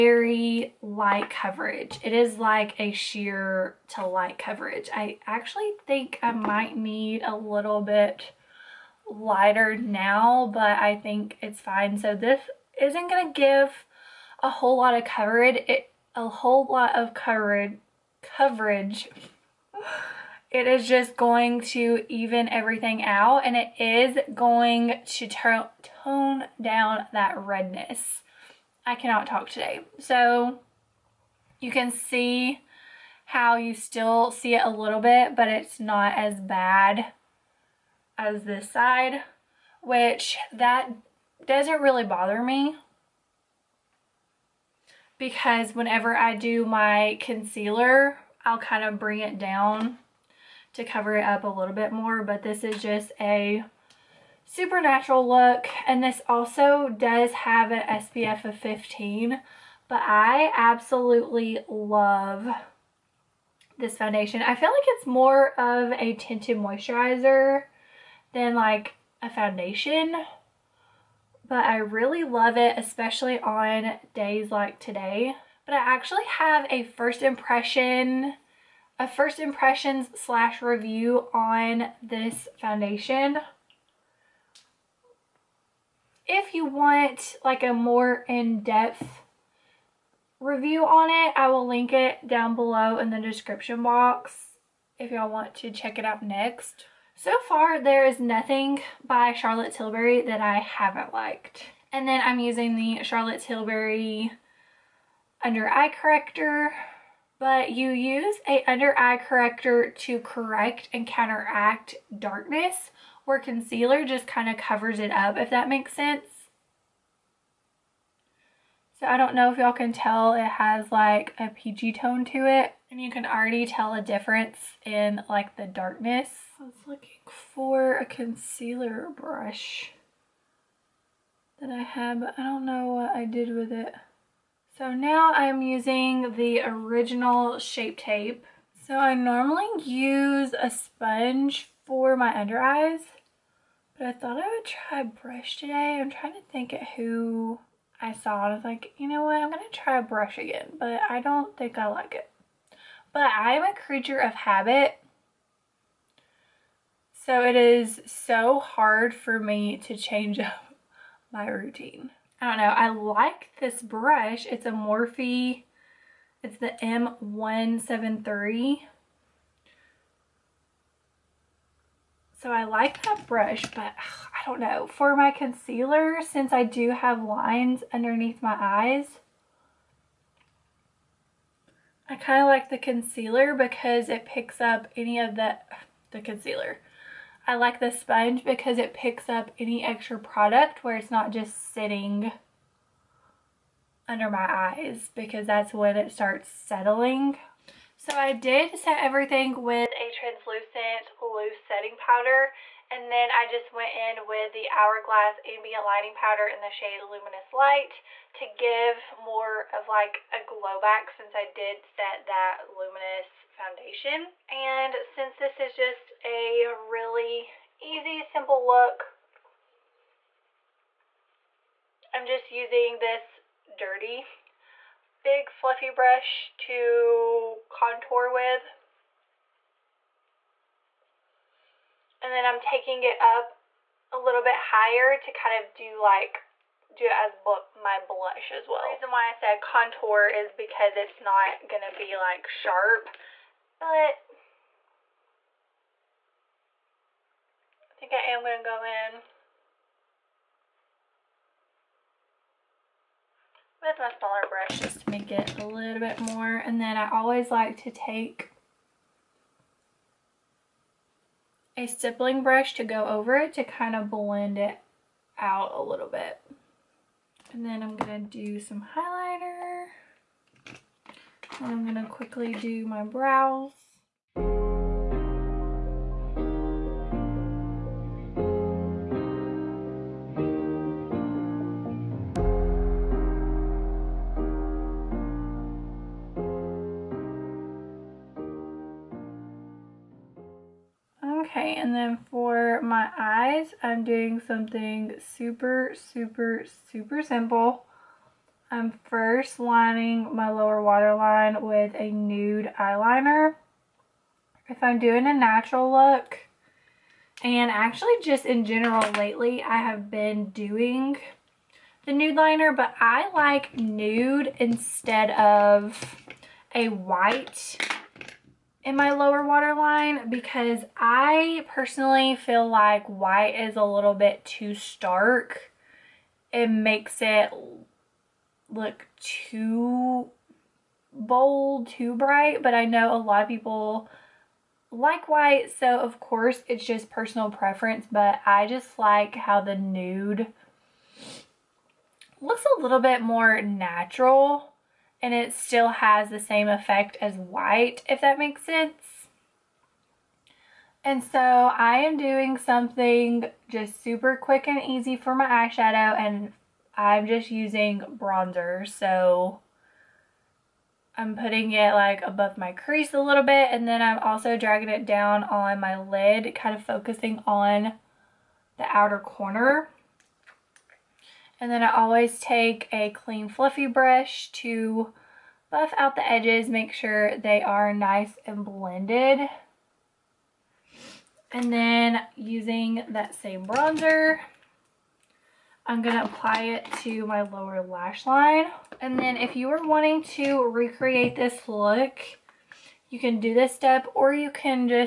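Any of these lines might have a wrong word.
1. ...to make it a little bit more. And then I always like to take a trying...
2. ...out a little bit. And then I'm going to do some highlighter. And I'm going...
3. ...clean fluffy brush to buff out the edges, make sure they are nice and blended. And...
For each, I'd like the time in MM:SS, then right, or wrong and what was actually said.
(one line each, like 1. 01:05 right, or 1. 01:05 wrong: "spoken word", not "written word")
1. 04:14 wrong: "stippling", not "trying"
2. 04:25 right
3. 06:13 right.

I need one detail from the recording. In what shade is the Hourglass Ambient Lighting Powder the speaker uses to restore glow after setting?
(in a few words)
Luminous Light.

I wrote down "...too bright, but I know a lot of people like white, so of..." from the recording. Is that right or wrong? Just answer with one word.
right.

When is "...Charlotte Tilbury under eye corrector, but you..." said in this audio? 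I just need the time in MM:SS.
01:43.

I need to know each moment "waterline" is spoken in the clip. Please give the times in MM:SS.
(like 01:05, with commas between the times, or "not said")
05:00, 05:19.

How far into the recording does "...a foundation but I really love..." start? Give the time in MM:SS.
01:09.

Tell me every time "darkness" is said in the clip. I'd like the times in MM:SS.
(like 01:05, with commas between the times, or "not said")
01:52, 02:05.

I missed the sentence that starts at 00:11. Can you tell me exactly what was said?
So this isn't going to give a whole lot of coverage.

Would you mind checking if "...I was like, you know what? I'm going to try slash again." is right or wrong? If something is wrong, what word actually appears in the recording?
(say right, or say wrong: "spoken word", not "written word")
wrong: "brush", not "slash".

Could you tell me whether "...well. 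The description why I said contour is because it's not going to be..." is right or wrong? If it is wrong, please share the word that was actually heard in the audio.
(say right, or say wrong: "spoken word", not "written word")
wrong: "reason", not "description".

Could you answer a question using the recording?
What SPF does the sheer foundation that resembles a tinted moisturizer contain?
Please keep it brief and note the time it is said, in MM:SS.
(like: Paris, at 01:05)
15, at 00:57.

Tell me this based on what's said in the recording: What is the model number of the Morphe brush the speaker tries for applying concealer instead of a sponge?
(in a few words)
M173.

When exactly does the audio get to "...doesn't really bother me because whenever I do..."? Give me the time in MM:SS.
00:41.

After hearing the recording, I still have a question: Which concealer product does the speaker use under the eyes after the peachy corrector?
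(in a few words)
original Shape Tape.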